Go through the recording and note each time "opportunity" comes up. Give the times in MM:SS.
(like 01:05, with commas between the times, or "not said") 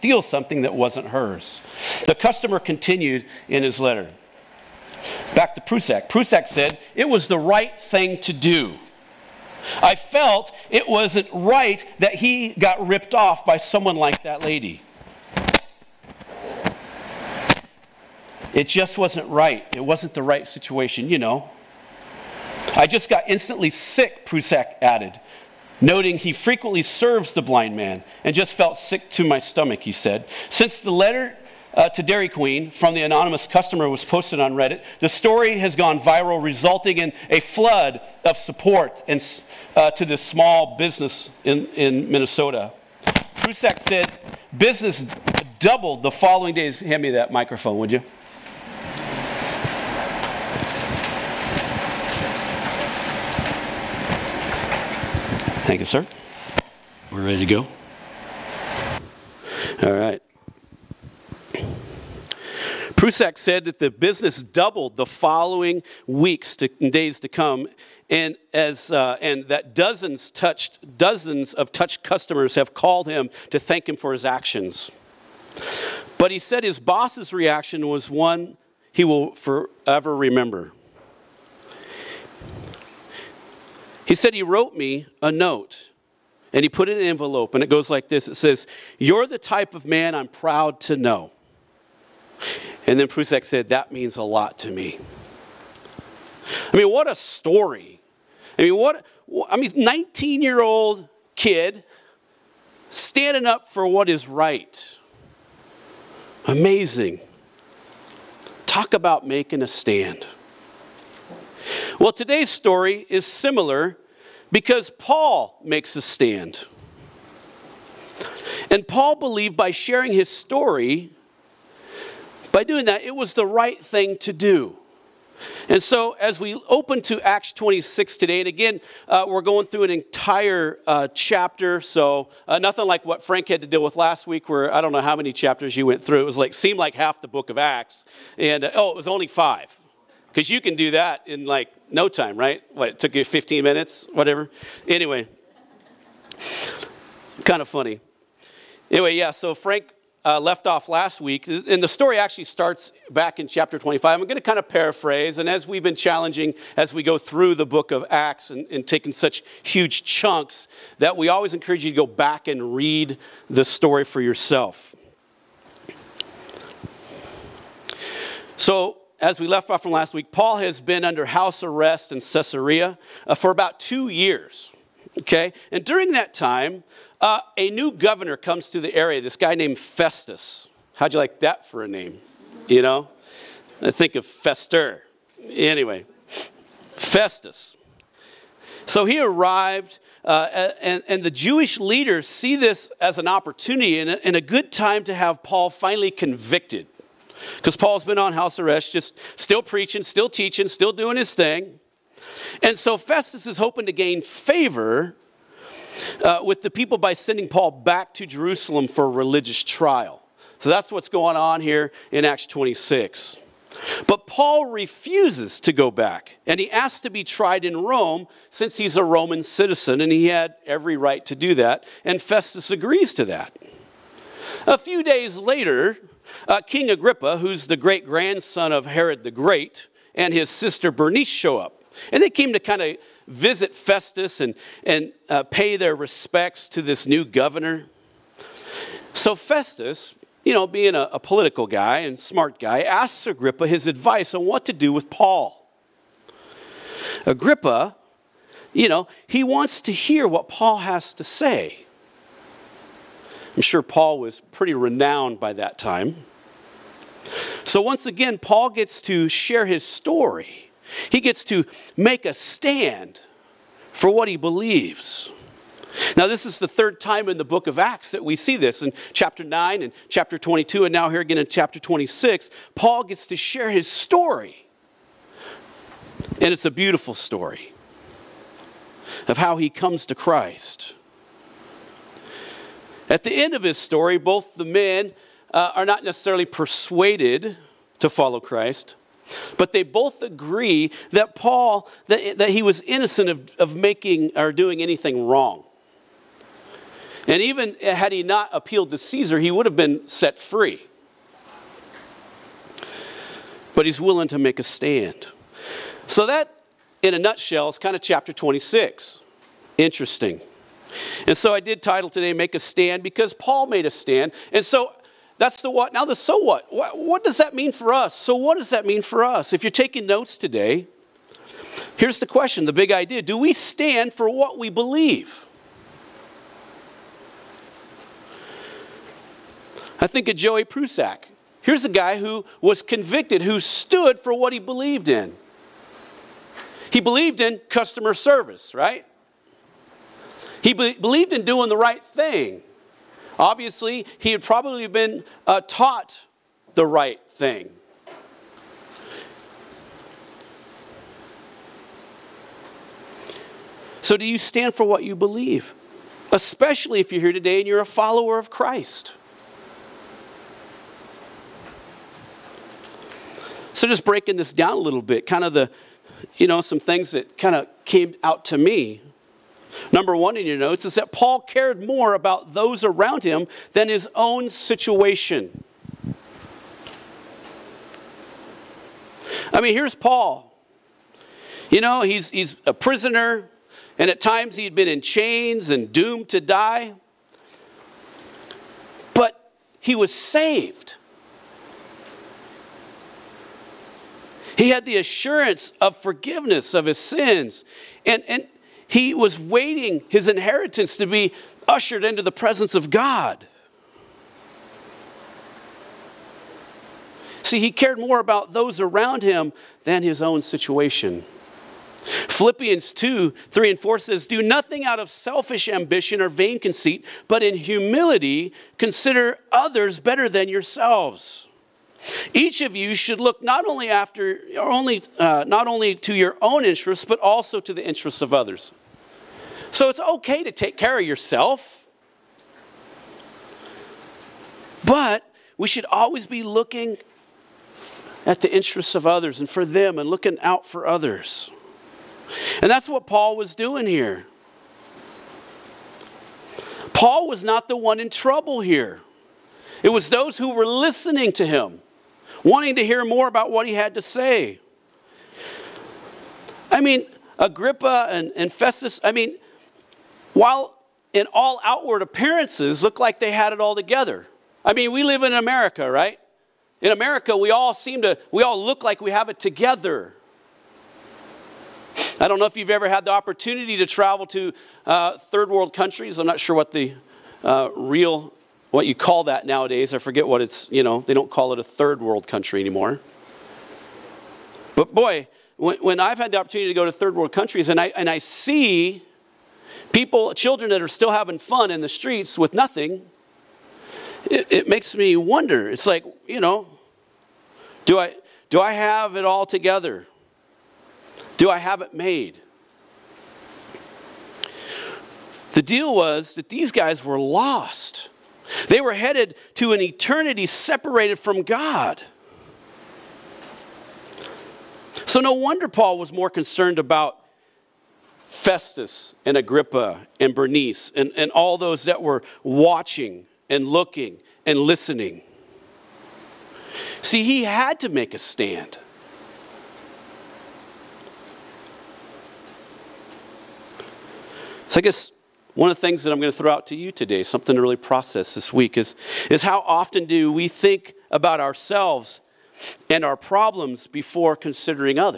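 03:13, 07:53, 08:06.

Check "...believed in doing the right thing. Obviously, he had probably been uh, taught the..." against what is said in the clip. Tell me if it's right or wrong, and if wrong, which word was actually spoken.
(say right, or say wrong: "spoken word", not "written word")
right.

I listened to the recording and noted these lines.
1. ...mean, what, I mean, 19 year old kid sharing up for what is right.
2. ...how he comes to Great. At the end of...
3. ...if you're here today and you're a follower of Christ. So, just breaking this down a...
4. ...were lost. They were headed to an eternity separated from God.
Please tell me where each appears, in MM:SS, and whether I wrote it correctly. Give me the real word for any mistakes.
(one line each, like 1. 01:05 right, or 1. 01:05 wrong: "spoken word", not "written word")
1. 01:38 wrong: "standing", not "sharing"
2. 04:39 wrong: "Christ", not "Great"
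3. 05:57 right
4. 08:27 right.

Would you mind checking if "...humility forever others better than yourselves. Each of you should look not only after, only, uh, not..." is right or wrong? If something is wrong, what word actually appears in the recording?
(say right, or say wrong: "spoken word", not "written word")
wrong: "consider", not "forever".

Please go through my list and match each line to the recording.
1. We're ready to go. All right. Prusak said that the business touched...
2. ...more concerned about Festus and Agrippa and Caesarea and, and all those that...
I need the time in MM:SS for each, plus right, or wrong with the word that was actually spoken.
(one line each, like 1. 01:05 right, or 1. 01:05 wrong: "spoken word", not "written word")
1. 00:57 wrong: "doubled", not "touched"
2. 08:36 wrong: "Bernice", not "Caesarea".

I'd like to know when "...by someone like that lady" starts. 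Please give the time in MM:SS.
00:13.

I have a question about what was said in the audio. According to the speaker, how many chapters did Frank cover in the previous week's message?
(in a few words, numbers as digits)
5.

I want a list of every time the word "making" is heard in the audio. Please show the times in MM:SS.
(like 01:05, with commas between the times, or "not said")
01:49, 04:53.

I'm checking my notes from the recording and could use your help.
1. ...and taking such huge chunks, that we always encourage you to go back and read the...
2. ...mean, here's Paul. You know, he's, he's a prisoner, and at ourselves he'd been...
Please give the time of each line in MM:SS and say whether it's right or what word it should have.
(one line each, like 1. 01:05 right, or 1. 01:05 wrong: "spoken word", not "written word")
1. 02:38 right
2. 06:19 wrong: "times", not "ourselves".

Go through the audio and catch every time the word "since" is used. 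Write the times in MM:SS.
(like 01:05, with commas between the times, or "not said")
00:30, 03:38.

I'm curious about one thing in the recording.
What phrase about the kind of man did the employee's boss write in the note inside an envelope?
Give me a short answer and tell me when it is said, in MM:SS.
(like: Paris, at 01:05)
the type of man I'm proud to know, at 01:29.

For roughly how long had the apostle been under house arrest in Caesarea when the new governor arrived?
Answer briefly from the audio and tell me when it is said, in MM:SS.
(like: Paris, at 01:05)
2 years, at 02:53.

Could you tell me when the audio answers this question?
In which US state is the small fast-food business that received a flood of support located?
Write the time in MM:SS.
00:42.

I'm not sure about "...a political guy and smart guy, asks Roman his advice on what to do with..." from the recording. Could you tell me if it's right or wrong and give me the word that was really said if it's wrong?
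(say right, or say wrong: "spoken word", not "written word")
wrong: "Agrippa", not "Roman".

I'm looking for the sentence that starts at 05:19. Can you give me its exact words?
If you're taking notes today, here's the question the big idea do we stand for what we believe?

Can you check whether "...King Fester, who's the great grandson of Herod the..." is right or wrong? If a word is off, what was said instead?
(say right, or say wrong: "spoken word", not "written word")
wrong: "Agrippa", not "Fester".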